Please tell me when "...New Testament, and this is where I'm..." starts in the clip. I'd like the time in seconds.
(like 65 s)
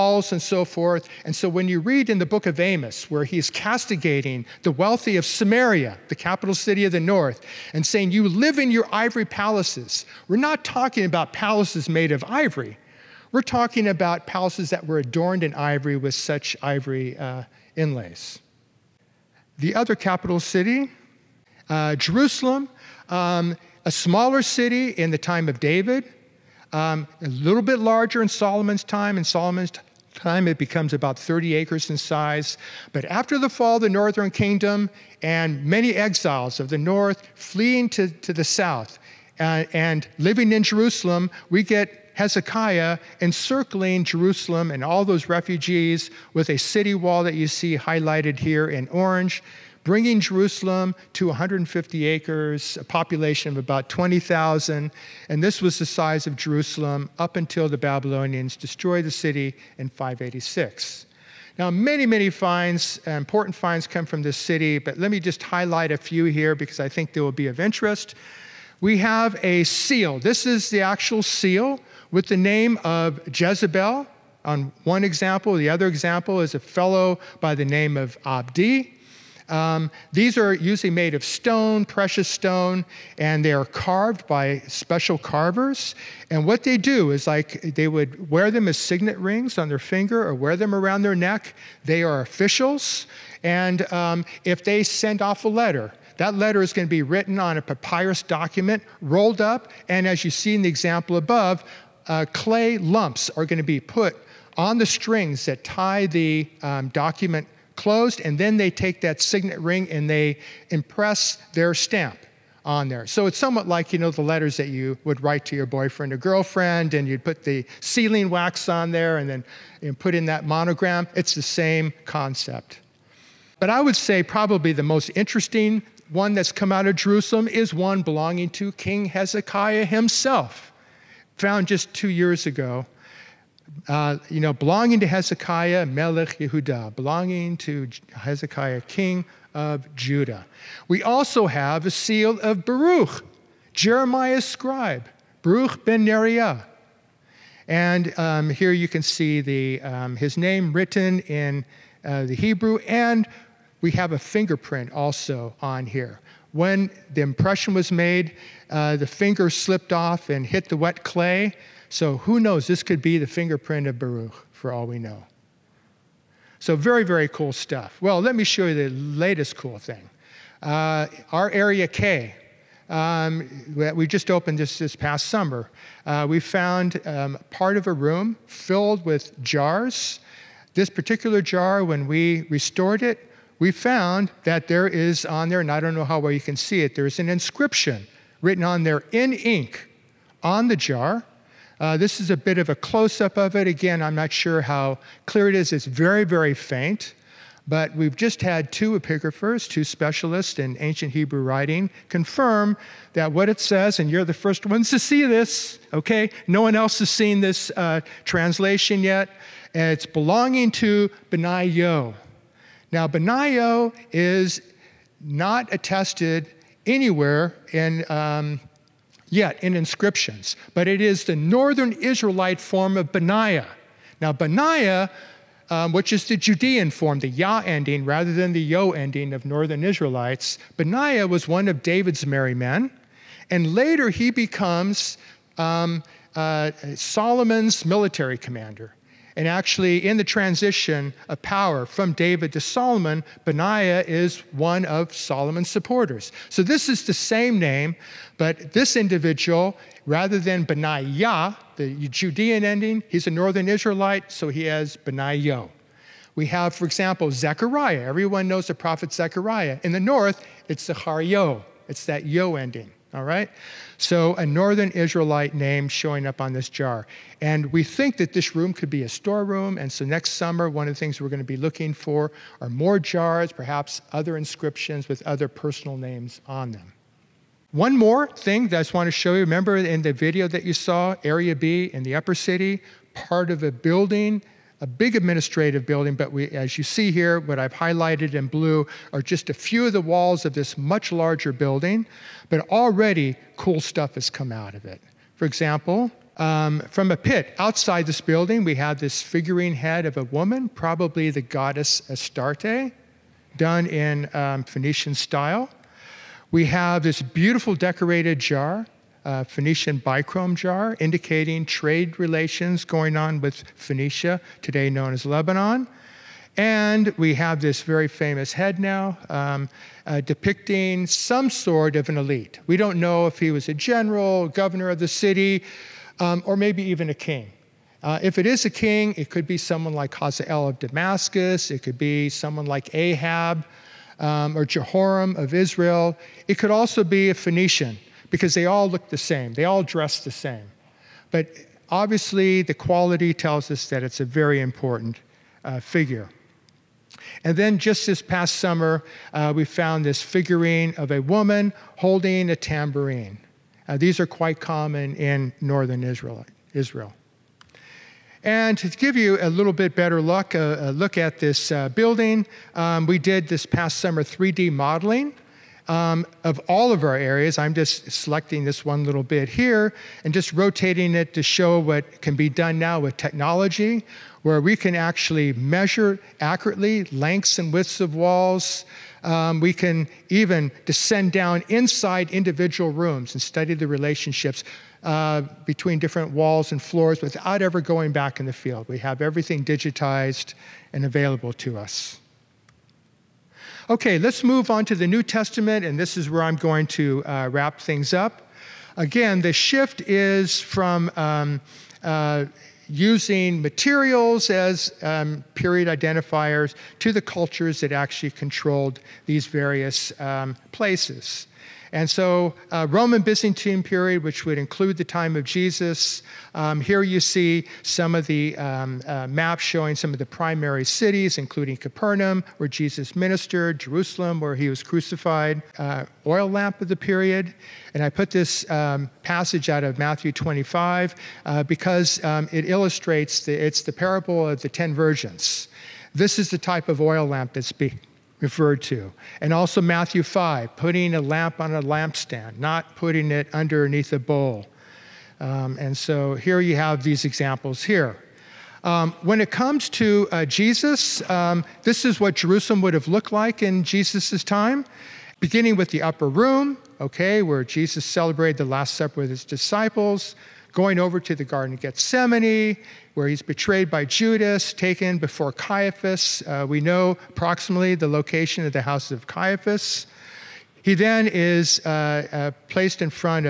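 395 s.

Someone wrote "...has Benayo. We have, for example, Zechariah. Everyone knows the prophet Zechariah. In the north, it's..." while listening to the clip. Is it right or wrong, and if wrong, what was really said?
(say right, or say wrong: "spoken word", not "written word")
right.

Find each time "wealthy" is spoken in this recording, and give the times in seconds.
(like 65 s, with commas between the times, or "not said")
4 s.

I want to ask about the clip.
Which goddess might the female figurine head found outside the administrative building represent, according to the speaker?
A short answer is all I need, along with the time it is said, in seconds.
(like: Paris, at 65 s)
Astarte, at 302 s.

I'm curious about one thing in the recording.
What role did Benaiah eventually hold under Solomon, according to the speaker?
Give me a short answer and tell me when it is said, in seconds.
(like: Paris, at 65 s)
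Military commander, at 237 s.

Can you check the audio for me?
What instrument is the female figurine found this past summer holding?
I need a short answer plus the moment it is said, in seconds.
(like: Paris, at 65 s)
A tambourine, at 352 s.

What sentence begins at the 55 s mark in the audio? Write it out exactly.
And this was the size of Jerusalem up until the Babylonians destroyed the city in 586.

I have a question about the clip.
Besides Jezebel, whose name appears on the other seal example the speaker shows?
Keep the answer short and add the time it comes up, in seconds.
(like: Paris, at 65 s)
Abdi, at 78 s.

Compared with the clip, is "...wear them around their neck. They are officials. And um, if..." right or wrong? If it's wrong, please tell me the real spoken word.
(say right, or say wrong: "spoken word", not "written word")
right.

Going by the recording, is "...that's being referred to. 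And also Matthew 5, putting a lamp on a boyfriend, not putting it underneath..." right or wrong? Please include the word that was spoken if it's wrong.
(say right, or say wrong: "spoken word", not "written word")
wrong: "lampstand", not "boyfriend".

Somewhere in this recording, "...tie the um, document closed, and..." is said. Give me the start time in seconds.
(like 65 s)
105 s.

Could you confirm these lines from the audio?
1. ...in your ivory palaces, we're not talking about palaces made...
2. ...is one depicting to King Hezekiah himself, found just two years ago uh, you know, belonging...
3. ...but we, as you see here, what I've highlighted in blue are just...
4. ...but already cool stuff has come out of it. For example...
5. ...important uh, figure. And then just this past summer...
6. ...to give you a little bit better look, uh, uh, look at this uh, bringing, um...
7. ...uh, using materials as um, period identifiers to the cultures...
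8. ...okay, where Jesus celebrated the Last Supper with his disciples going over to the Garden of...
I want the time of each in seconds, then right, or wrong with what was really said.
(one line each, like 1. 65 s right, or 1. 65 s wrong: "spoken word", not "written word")
1. 8 s right
2. 127 s wrong: "belonging", not "depicting"
3. 286 s right
4. 292 s right
5. 344 s right
6. 358 s wrong: "building", not "bringing"
7. 402 s right
8. 457 s right.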